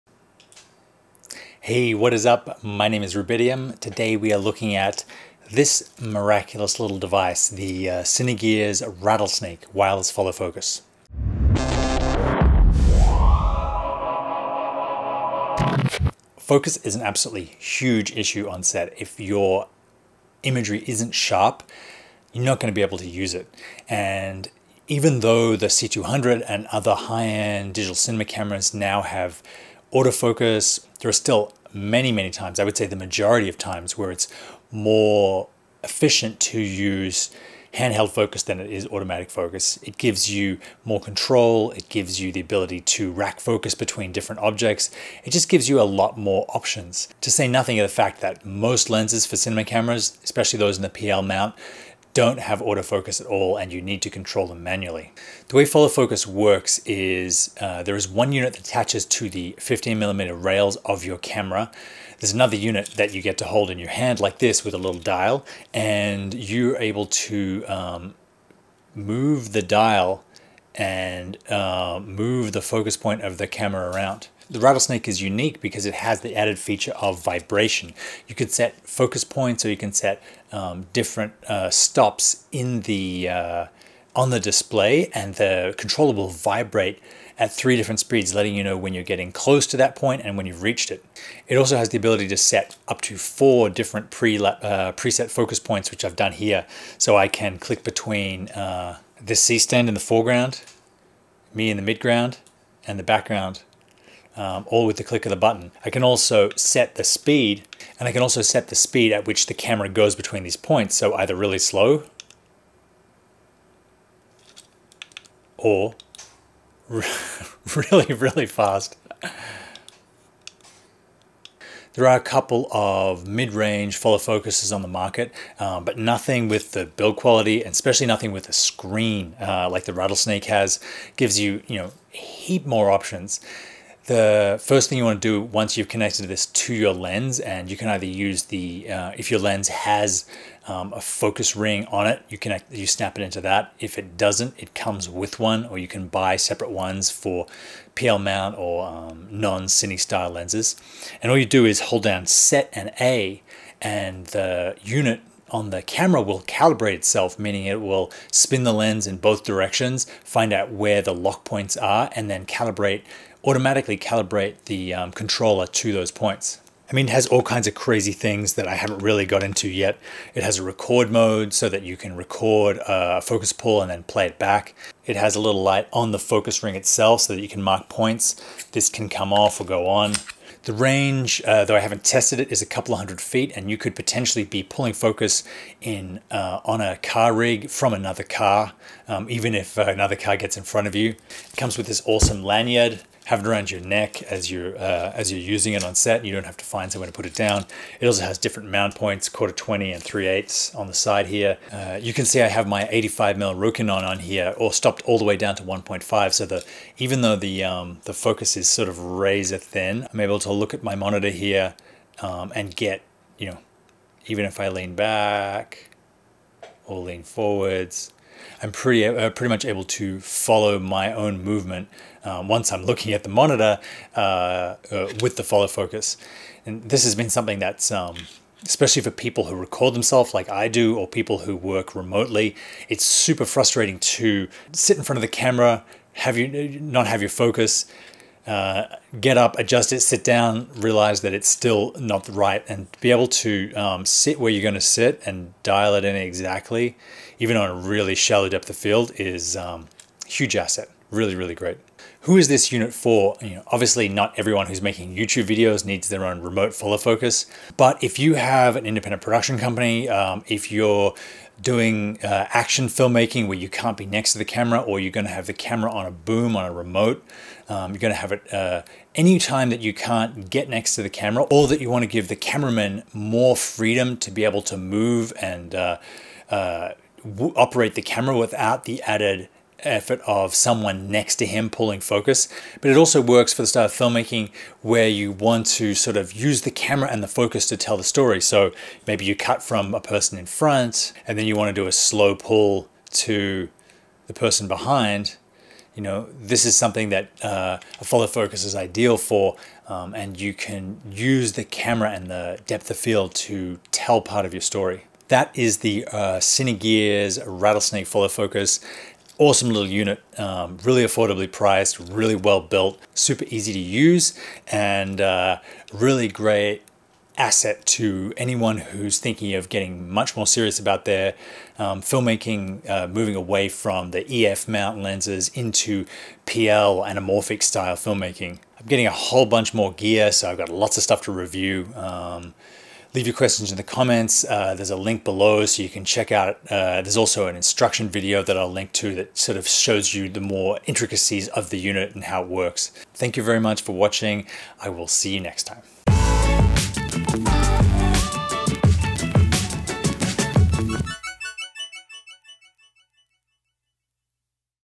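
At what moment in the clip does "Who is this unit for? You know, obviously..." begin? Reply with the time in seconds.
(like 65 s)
252 s.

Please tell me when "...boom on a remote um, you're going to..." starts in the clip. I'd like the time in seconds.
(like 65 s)
266 s.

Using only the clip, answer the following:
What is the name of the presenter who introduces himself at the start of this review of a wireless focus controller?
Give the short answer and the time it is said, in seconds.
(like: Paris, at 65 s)
Rubidium, at 3 s.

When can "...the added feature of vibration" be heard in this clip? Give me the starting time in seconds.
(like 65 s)
76 s.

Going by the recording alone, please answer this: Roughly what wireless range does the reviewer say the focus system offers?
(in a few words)
A couple of hundred feet.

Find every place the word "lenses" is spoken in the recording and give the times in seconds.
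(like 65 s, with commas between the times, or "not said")
48 s, 150 s, 324 s.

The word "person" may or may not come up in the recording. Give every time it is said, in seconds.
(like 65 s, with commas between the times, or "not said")
290 s, 294 s.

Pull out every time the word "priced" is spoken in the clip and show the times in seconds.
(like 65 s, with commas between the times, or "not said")
311 s.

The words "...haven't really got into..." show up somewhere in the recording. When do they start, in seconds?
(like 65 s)
168 s.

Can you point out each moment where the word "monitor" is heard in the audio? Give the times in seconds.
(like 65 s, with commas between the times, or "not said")
210 s, 223 s.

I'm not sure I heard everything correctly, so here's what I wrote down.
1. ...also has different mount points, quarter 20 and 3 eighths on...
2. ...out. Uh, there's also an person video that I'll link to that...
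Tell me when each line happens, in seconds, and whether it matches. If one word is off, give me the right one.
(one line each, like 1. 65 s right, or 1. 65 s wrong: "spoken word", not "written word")
1. 198 s right
2. 336 s wrong: "instruction", not "person".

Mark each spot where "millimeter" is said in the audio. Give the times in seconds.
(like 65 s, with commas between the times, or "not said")
59 s.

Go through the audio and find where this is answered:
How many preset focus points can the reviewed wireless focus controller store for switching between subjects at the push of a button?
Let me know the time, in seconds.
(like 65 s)
93 s.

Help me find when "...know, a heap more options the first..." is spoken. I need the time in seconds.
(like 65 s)
131 s.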